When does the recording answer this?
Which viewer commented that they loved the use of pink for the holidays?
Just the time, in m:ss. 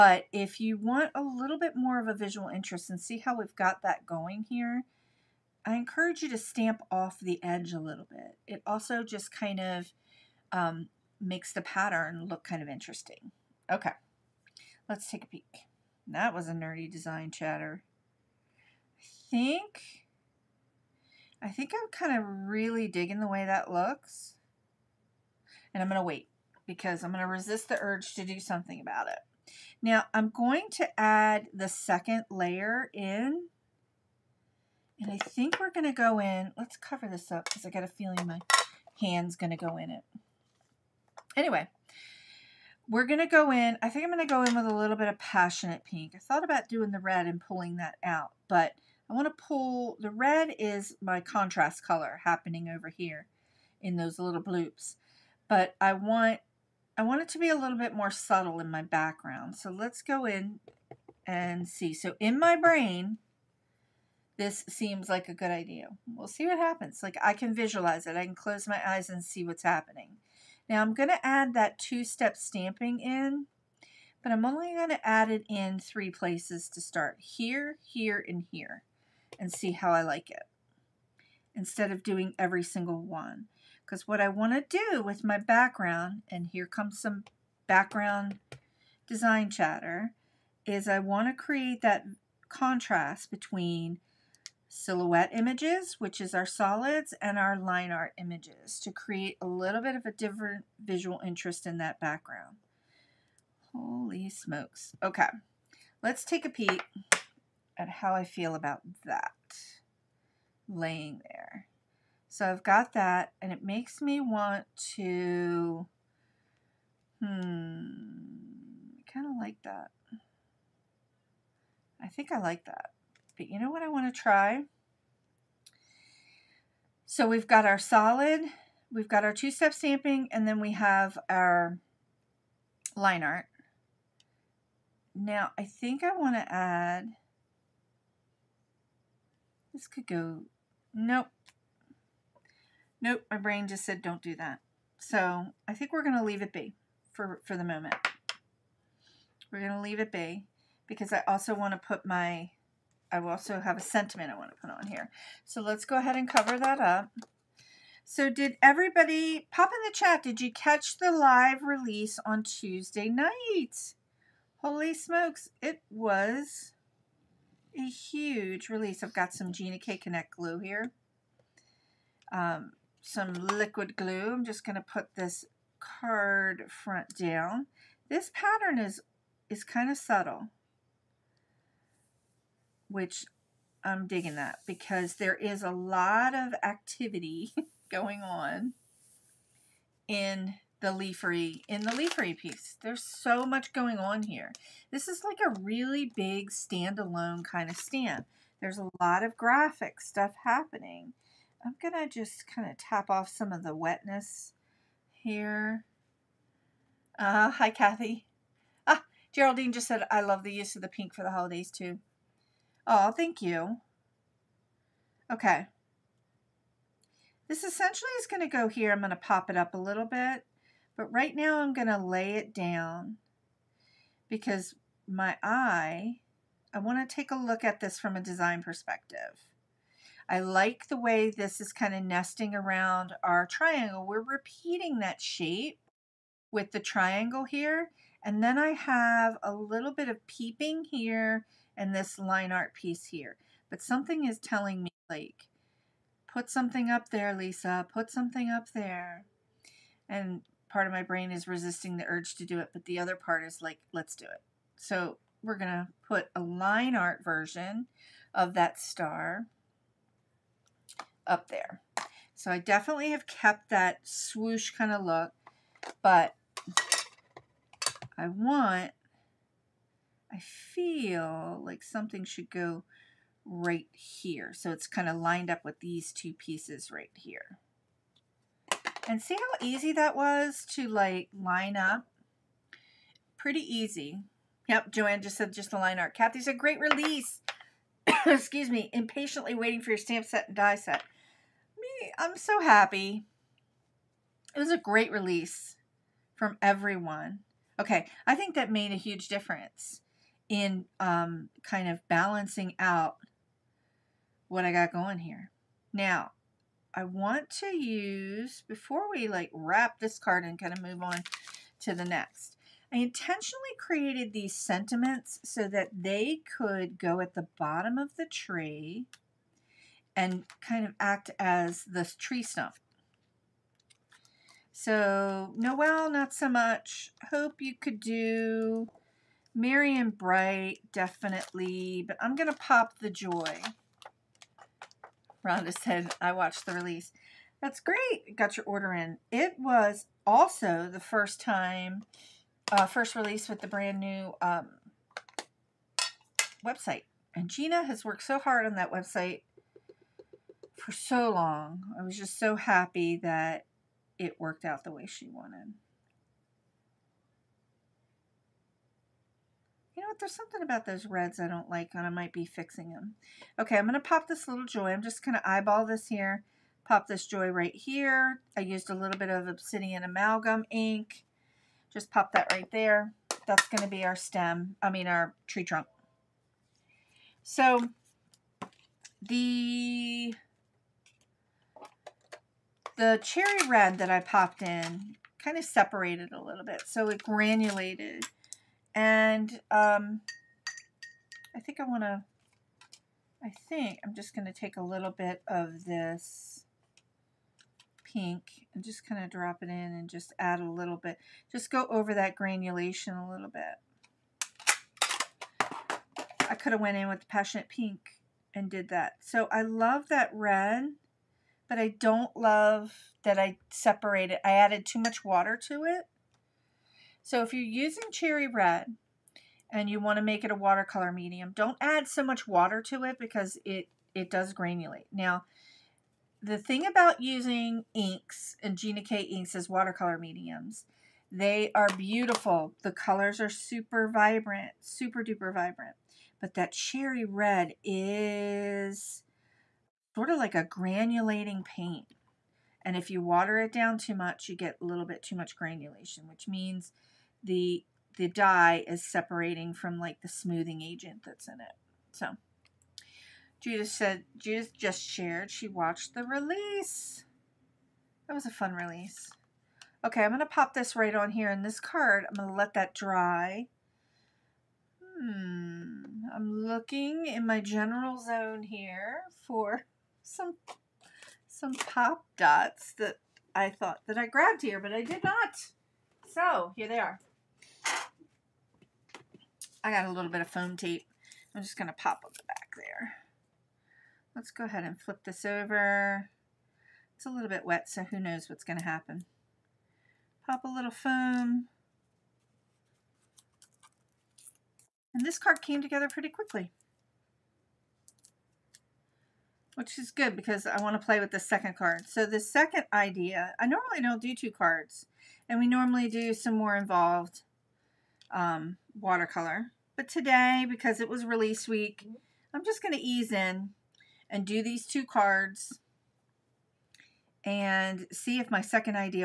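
3:29.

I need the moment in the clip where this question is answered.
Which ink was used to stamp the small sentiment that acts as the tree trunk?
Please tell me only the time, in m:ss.
6:09.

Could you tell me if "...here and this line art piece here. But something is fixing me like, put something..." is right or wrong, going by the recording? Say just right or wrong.
wrong.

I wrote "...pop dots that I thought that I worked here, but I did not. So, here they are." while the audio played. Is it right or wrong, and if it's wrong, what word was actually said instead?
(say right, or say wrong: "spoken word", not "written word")
wrong: "grabbed", not "worked".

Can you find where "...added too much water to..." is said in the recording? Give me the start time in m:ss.
6:54.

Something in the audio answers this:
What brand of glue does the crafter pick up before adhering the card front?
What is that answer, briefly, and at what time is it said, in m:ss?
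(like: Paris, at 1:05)
Gina K Connect, at 2:49.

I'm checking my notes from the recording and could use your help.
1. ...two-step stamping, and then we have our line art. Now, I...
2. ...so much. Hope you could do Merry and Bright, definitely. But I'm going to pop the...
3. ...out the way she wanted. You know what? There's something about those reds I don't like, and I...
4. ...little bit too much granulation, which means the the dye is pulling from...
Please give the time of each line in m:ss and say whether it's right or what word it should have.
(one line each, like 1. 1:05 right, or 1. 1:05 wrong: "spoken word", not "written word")
1. 2:09 right
2. 5:26 right
3. 5:54 right
4. 7:24 wrong: "separating", not "pulling".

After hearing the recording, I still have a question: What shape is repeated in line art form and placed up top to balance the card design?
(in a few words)
star.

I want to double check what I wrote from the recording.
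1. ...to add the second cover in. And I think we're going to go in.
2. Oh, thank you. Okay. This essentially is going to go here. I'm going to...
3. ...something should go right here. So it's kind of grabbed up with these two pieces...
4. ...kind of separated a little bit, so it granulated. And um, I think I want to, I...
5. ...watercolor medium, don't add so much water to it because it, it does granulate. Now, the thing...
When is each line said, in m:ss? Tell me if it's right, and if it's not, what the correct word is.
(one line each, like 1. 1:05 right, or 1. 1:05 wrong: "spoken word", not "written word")
1. 0:30 wrong: "layer", not "cover"
2. 3:32 right
3. 4:31 wrong: "lined", not "grabbed"
4. 6:25 right
5. 7:00 right.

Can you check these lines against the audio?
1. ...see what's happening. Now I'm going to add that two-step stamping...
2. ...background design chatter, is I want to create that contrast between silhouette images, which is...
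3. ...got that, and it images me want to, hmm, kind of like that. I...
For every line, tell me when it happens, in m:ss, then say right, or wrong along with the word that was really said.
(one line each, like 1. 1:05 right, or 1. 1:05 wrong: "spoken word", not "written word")
1. 1:09 right
2. 1:27 right
3. 1:52 wrong: "makes", not "images".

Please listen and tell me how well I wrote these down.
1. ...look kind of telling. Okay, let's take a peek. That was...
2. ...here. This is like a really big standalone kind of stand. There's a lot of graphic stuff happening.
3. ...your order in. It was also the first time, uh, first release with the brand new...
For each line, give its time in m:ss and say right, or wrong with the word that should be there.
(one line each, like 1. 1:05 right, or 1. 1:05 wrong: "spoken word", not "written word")
1. 0:12 wrong: "interesting", not "telling"
2. 3:14 right
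3. 5:38 right.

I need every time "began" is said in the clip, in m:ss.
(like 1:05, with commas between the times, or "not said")
not said.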